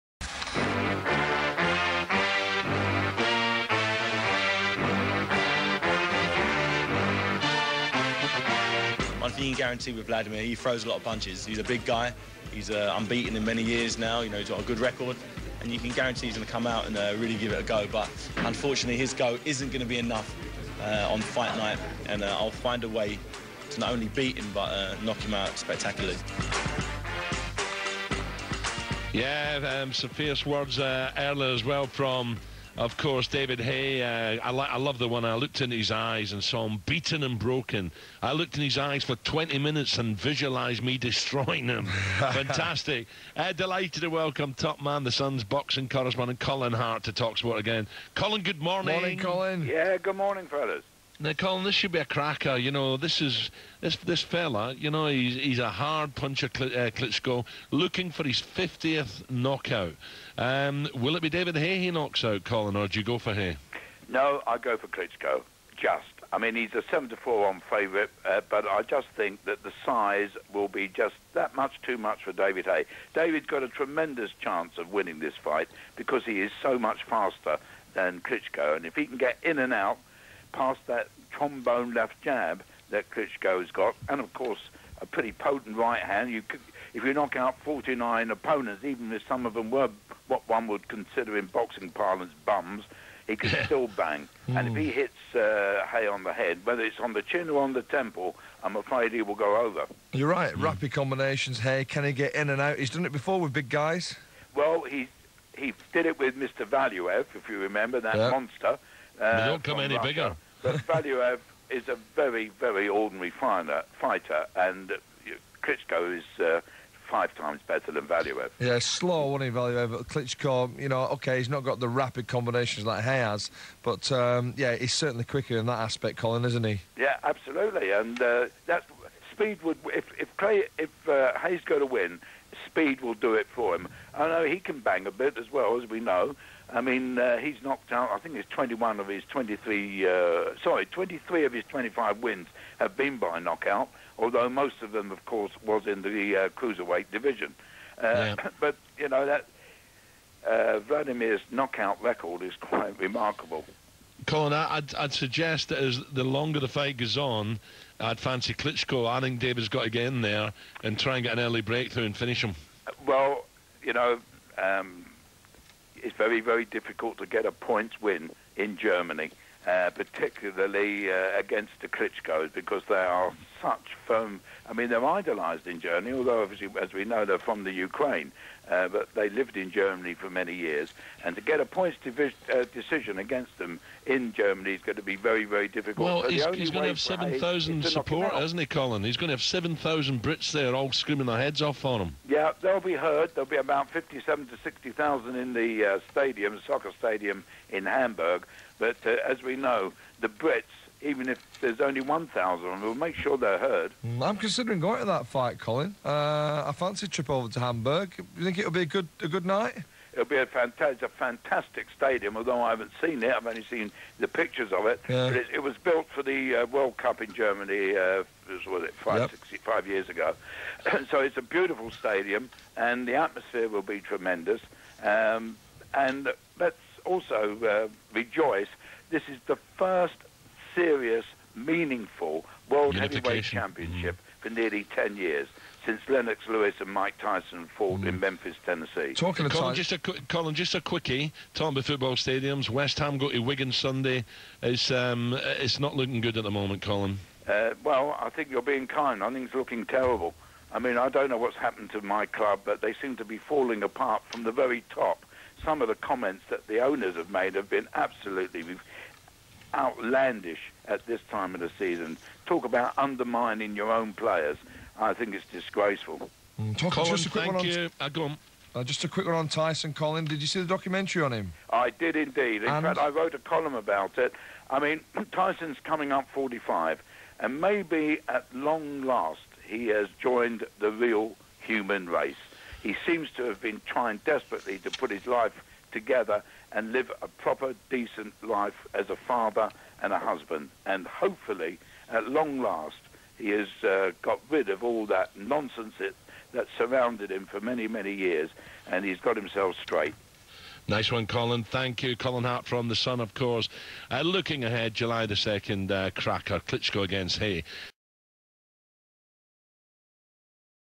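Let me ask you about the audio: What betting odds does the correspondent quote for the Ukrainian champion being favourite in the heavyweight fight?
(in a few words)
7 to 4 on.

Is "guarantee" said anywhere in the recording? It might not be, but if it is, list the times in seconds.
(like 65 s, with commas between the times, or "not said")
9 s, 15 s.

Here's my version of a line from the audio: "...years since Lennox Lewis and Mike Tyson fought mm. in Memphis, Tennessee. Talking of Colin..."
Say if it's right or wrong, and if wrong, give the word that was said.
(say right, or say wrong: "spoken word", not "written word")
right.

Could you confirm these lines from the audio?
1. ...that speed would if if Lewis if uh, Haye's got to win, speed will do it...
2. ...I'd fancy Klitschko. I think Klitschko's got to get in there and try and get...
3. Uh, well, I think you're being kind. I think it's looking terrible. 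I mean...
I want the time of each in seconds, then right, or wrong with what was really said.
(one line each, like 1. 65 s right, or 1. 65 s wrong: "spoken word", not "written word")
1. 128 s wrong: "Clay", not "Lewis"
2. 157 s wrong: "David", not "Klitschko"
3. 247 s right.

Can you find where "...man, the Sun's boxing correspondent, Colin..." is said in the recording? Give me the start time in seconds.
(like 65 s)
44 s.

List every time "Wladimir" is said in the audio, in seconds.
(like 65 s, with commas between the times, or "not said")
10 s, 150 s.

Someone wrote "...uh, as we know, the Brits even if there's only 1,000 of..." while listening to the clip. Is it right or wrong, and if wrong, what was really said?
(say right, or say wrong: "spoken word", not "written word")
right.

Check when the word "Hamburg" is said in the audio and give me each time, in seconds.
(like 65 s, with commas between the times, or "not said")
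197 s, 207 s.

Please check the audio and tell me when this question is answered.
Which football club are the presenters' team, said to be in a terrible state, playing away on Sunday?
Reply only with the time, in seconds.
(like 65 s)
243 s.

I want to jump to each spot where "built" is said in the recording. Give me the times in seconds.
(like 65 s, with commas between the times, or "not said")
215 s.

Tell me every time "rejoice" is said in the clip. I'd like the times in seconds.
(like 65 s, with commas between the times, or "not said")
228 s.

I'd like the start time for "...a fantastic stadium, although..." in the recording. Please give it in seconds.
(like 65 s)
211 s.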